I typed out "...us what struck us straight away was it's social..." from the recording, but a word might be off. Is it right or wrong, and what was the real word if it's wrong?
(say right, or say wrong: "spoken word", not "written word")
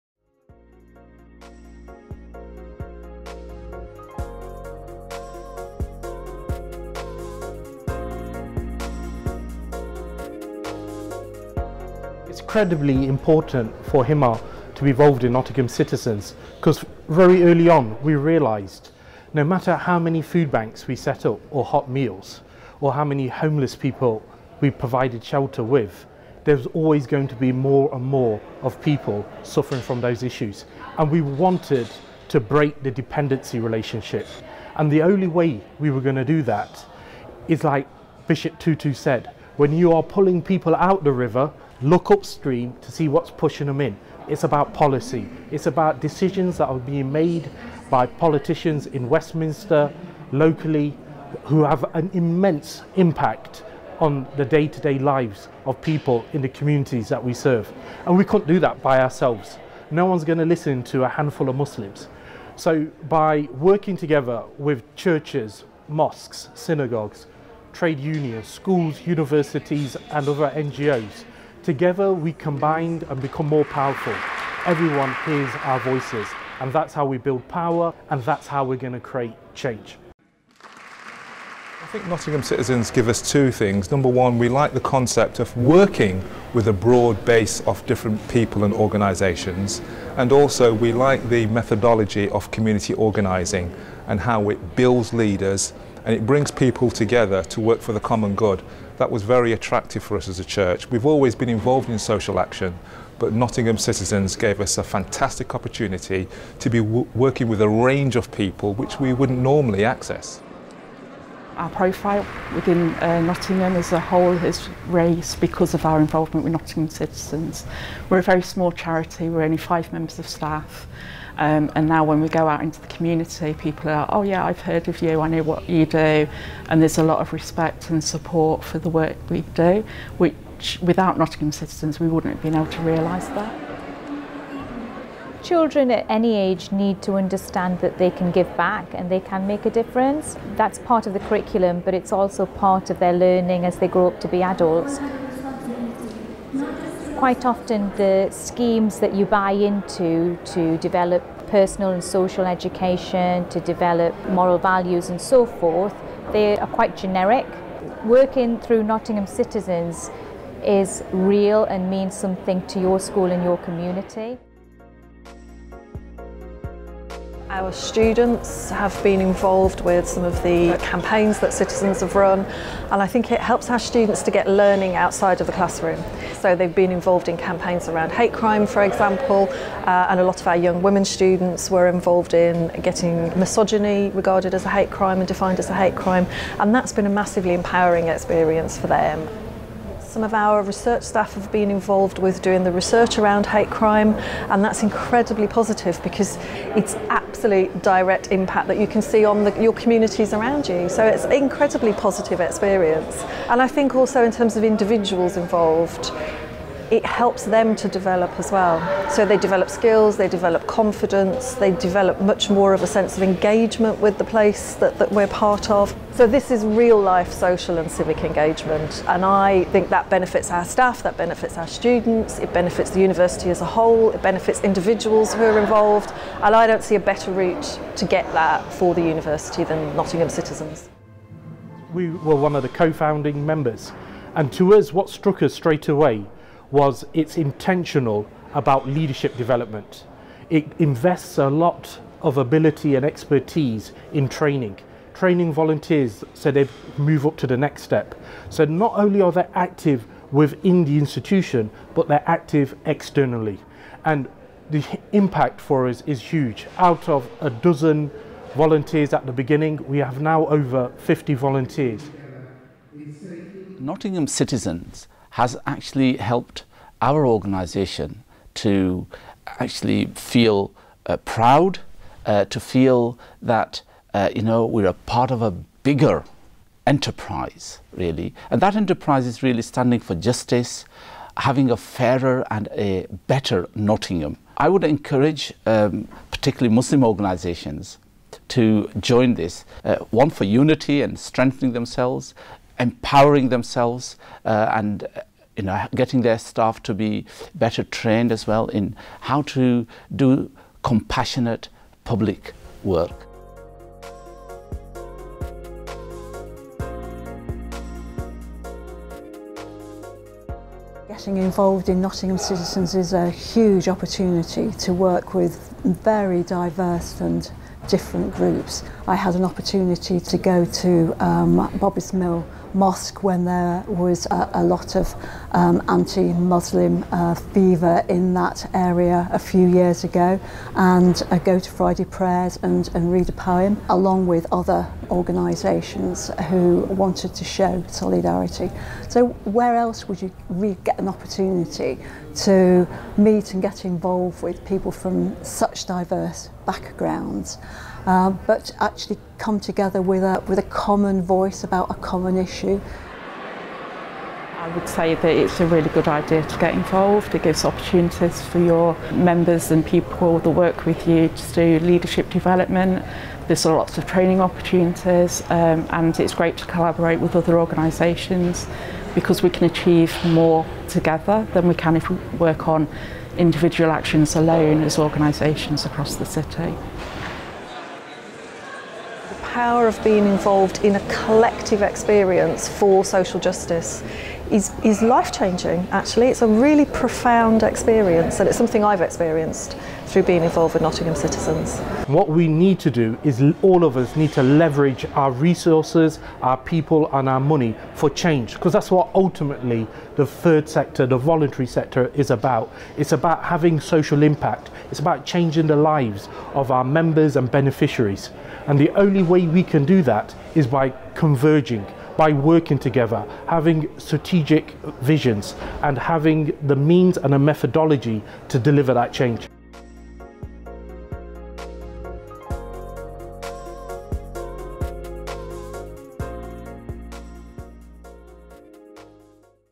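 wrong: "intentional", not "social".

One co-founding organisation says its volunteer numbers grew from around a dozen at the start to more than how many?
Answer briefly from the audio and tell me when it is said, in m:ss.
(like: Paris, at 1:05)
50, at 4:20.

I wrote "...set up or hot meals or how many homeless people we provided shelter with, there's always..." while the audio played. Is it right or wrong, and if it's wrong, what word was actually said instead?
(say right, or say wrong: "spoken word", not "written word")
right.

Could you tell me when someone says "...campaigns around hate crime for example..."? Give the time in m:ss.
2:57.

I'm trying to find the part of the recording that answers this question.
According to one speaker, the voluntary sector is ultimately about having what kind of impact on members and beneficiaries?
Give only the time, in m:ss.
6:43.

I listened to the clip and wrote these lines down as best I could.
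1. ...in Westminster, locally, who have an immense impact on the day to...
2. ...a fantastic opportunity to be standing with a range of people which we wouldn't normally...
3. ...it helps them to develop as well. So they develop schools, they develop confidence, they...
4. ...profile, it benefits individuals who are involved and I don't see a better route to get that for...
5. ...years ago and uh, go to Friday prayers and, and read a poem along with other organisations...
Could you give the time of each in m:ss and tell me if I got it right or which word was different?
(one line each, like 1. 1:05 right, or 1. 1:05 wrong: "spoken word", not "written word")
1. 0:48 right
2. 1:44 wrong: "working", not "standing"
3. 3:26 wrong: "skills", not "schools"
4. 3:43 wrong: "whole", not "profile"
5. 5:29 right.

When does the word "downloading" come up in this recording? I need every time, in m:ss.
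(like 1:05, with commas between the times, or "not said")
not said.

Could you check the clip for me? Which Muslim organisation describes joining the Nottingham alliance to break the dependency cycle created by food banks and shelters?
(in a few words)
Himmah.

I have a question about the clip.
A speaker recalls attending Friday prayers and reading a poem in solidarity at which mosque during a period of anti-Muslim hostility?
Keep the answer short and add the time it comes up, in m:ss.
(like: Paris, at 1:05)
Bobbers Mill mosque, at 5:21.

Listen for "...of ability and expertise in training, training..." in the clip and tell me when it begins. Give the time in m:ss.
4:02.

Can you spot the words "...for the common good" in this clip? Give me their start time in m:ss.
1:37.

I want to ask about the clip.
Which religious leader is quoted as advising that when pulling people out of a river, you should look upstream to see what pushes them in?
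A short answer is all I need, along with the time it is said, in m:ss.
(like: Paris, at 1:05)
Bishop Tutu, at 0:38.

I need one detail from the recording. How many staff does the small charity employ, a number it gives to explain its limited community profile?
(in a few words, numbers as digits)
5.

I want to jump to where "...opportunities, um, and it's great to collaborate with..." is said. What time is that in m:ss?
6:04.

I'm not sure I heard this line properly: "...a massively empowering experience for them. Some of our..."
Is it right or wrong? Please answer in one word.
right.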